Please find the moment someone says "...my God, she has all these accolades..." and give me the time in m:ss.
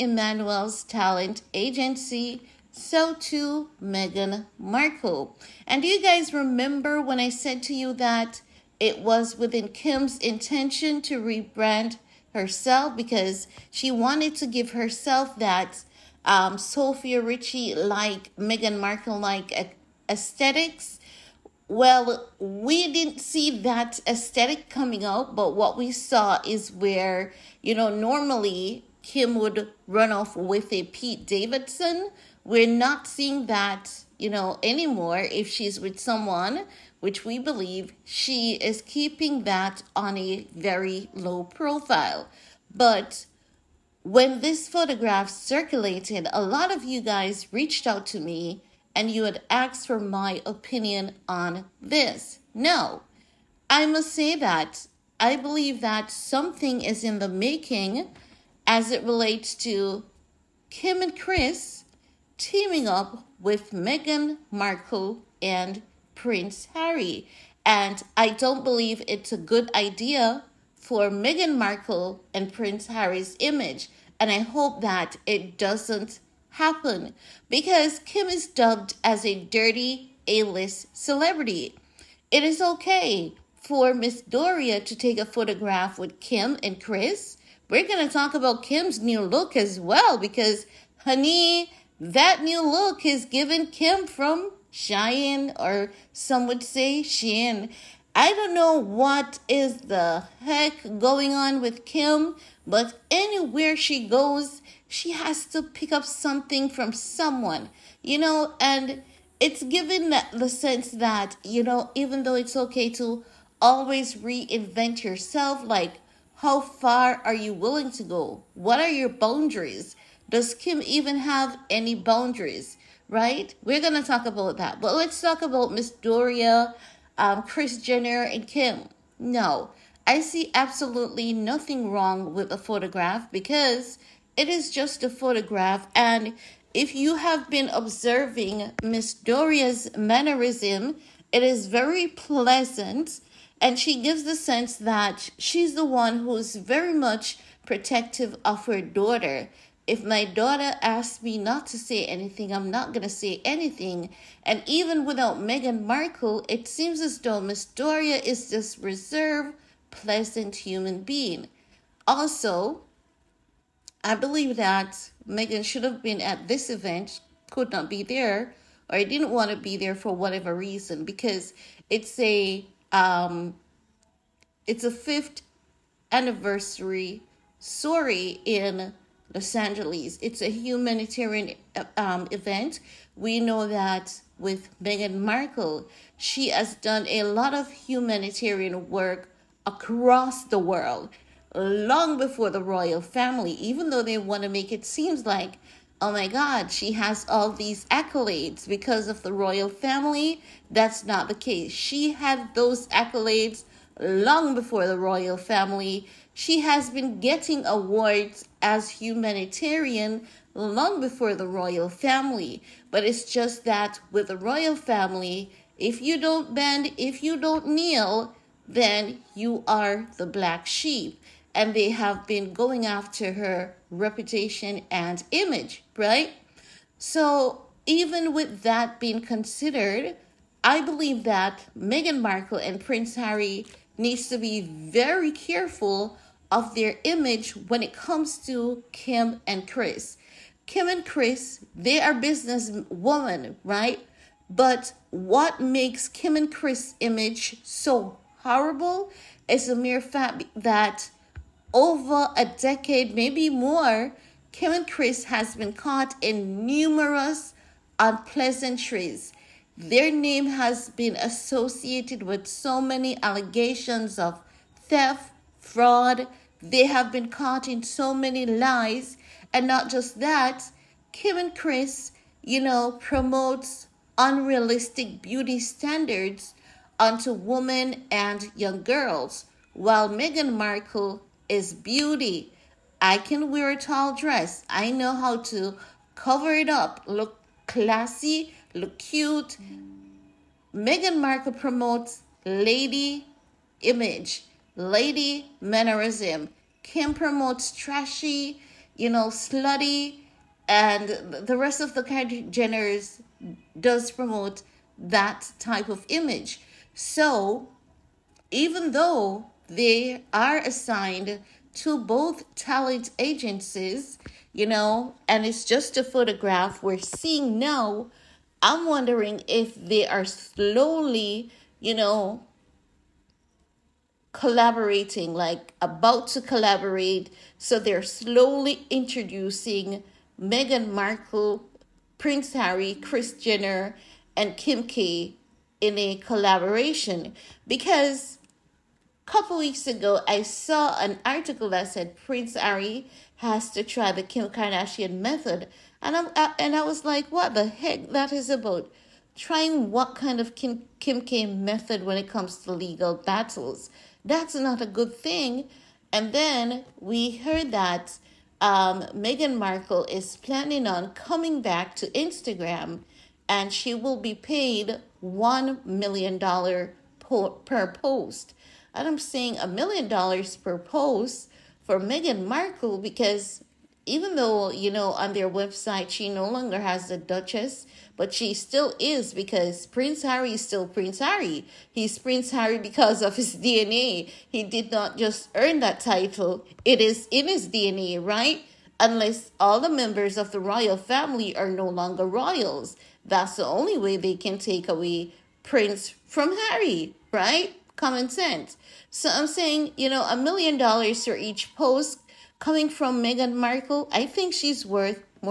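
3:16.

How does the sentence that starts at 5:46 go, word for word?
And I, uh, and I was like, what the heck that is about?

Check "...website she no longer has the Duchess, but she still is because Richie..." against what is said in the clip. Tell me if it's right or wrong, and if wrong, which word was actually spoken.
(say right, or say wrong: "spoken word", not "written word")
wrong: "Prince", not "Richie".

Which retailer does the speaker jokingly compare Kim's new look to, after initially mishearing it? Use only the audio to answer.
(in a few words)
Shein.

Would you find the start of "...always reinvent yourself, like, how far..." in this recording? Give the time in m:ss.
1:53.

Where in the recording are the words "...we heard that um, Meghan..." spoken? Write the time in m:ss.
5:56.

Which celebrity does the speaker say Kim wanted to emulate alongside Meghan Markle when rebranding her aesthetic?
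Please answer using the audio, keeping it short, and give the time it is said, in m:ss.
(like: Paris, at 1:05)
Sofia Richie, at 0:16.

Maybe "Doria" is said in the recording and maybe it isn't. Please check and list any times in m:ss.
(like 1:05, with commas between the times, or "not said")
1:24, 2:05, 2:19, 2:37.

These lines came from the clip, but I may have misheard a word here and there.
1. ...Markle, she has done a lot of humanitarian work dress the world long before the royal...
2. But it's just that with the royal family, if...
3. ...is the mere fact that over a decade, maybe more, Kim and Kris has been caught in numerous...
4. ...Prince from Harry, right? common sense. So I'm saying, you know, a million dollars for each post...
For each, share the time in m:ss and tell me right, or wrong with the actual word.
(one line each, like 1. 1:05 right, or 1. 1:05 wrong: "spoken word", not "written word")
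1. 3:05 wrong: "across", not "dress"
2. 3:32 right
3. 4:09 right
4. 6:35 right.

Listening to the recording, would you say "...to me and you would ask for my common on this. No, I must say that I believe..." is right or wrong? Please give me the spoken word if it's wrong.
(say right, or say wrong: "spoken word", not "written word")
wrong: "opinion", not "common".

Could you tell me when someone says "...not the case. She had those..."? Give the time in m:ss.
3:21.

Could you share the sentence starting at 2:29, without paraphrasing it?
If my daughter asks me not to say anything, I'm not going to say anything.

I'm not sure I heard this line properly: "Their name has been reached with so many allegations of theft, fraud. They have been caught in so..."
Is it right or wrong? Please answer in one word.
wrong.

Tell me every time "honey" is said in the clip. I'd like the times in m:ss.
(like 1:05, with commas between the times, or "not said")
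1:31.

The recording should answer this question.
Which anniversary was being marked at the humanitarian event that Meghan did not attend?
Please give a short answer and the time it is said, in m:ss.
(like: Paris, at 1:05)
Fifth anniversary, at 2:54.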